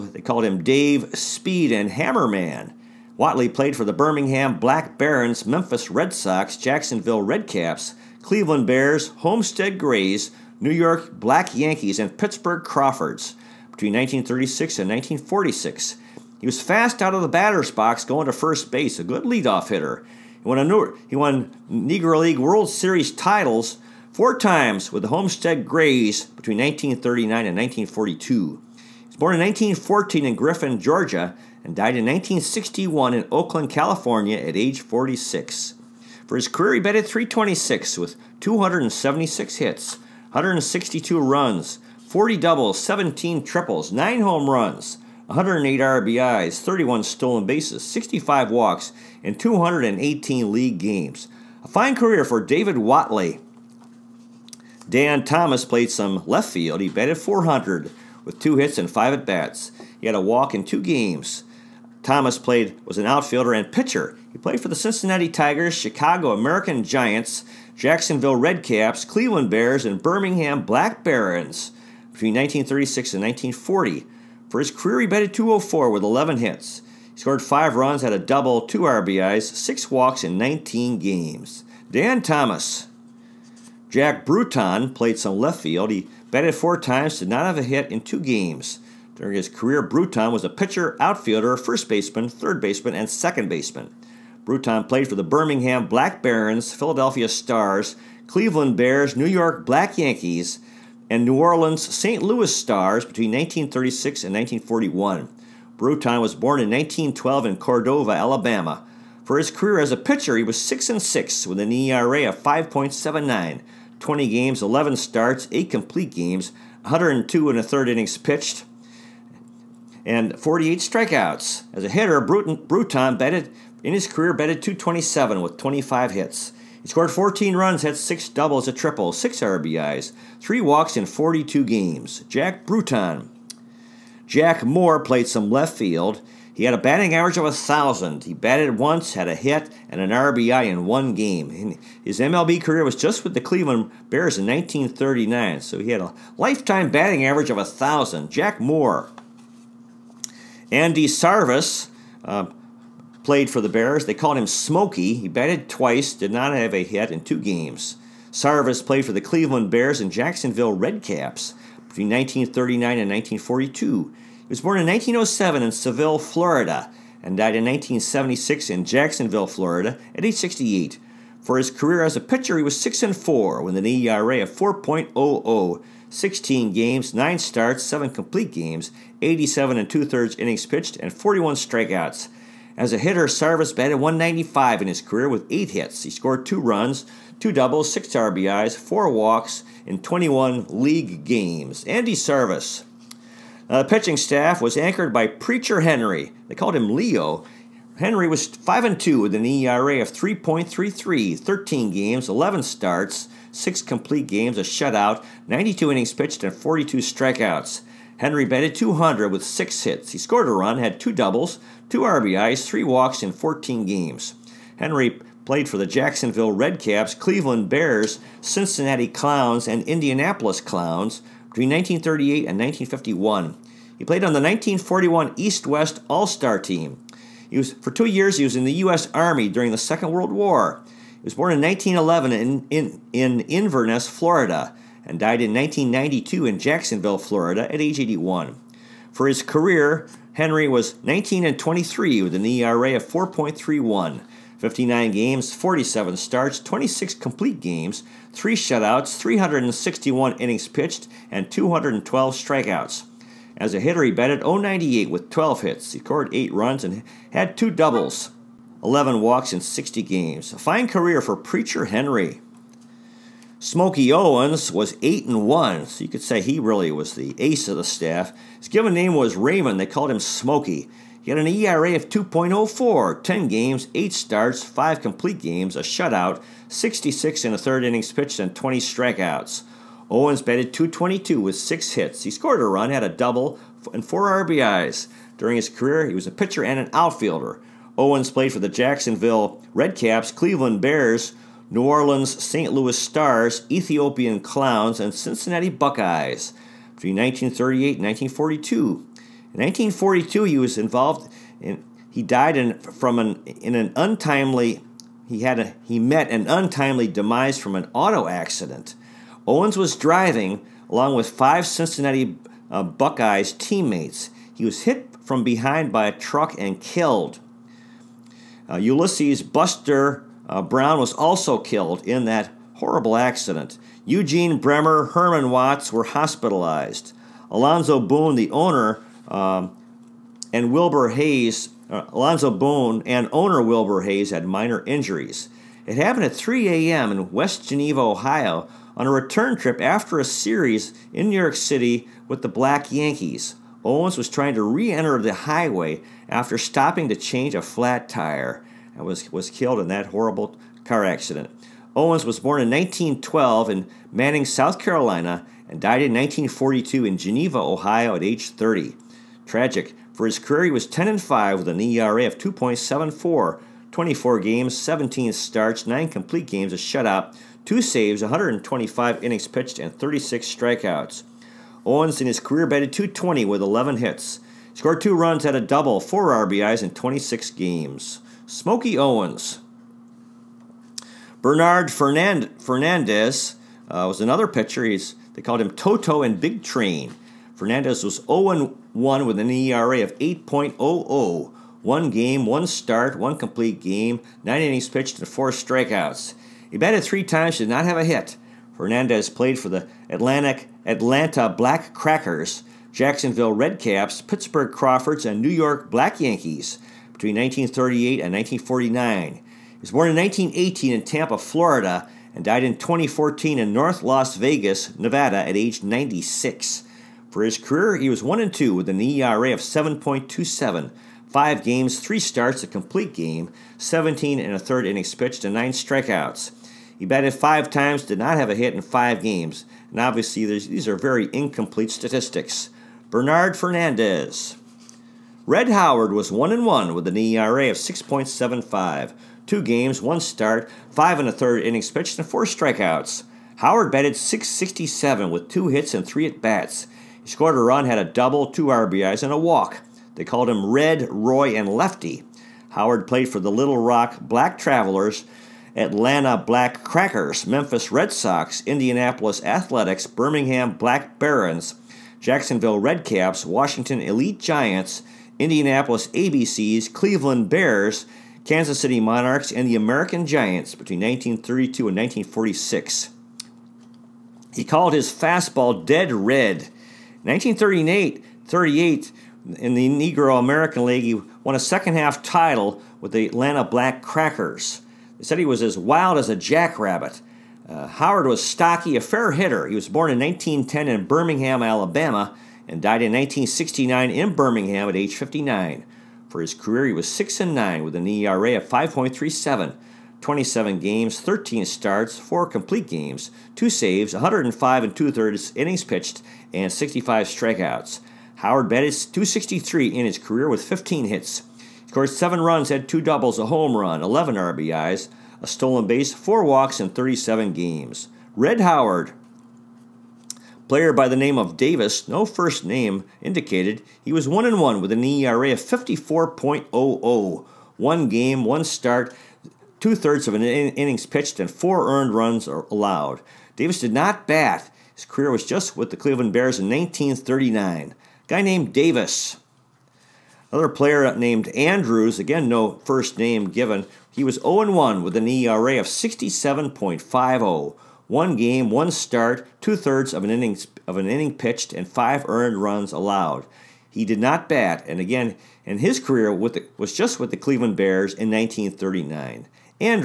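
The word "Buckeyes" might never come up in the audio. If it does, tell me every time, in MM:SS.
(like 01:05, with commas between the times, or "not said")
04:55, 05:12.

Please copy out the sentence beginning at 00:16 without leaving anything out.
He was fast out of the batter's box going to first base, a good leadoff hitter.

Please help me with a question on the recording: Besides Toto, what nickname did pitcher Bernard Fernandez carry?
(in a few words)
Big Train.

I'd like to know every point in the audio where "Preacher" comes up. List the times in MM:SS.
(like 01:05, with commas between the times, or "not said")
03:15, 04:21.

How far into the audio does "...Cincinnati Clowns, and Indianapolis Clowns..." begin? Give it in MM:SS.
03:38.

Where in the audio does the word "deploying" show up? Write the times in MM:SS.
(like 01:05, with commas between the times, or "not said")
not said.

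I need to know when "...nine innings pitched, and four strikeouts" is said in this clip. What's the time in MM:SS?
06:34.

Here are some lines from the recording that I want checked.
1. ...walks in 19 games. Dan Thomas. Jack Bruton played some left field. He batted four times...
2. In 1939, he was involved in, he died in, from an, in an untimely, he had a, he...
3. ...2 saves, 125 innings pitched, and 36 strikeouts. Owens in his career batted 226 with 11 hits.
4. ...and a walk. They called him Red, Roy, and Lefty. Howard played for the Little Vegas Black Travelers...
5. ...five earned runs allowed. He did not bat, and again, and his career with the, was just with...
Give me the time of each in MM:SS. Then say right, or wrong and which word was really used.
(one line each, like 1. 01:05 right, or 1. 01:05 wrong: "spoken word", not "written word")
1. 01:19 right
2. 04:58 wrong: "1942", not "1939"
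3. 06:07 wrong: "220", not "226"
4. 07:29 wrong: "Rock", not "Vegas"
5. 09:11 right.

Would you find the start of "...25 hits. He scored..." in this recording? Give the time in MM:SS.
02:05.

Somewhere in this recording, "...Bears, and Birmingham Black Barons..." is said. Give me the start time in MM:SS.
01:09.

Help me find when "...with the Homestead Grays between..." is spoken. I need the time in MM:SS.
00:24.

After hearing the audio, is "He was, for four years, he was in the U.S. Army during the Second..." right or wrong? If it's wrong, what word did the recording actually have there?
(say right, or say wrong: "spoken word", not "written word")
wrong: "two", not "four".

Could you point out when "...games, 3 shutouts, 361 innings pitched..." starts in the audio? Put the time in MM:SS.
04:07.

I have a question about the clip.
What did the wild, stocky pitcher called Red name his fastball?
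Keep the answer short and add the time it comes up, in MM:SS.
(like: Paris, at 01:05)
dead red, at 07:55.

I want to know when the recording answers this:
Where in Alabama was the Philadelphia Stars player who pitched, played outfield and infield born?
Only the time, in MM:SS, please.
01:47.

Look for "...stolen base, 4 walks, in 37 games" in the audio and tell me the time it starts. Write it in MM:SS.
08:35.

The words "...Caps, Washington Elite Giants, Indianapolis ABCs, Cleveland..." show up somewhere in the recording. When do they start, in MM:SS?
07:43.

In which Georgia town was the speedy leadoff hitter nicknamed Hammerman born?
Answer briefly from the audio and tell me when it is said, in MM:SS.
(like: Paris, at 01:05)
Griffin, Georgia, at 00:30.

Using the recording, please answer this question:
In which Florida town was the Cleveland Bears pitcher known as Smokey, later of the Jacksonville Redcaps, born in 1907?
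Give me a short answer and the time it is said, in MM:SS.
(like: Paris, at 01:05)
Seville, Florida, at 02:45.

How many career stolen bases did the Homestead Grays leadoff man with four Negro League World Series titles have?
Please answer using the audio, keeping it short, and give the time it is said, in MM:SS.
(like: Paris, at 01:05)
31, at 00:46.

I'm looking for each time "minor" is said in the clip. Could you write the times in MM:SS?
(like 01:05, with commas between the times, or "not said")
05:34.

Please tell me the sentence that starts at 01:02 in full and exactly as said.
Thomas played was an outfielder and pitcher.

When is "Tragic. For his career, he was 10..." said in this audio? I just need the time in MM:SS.
05:59.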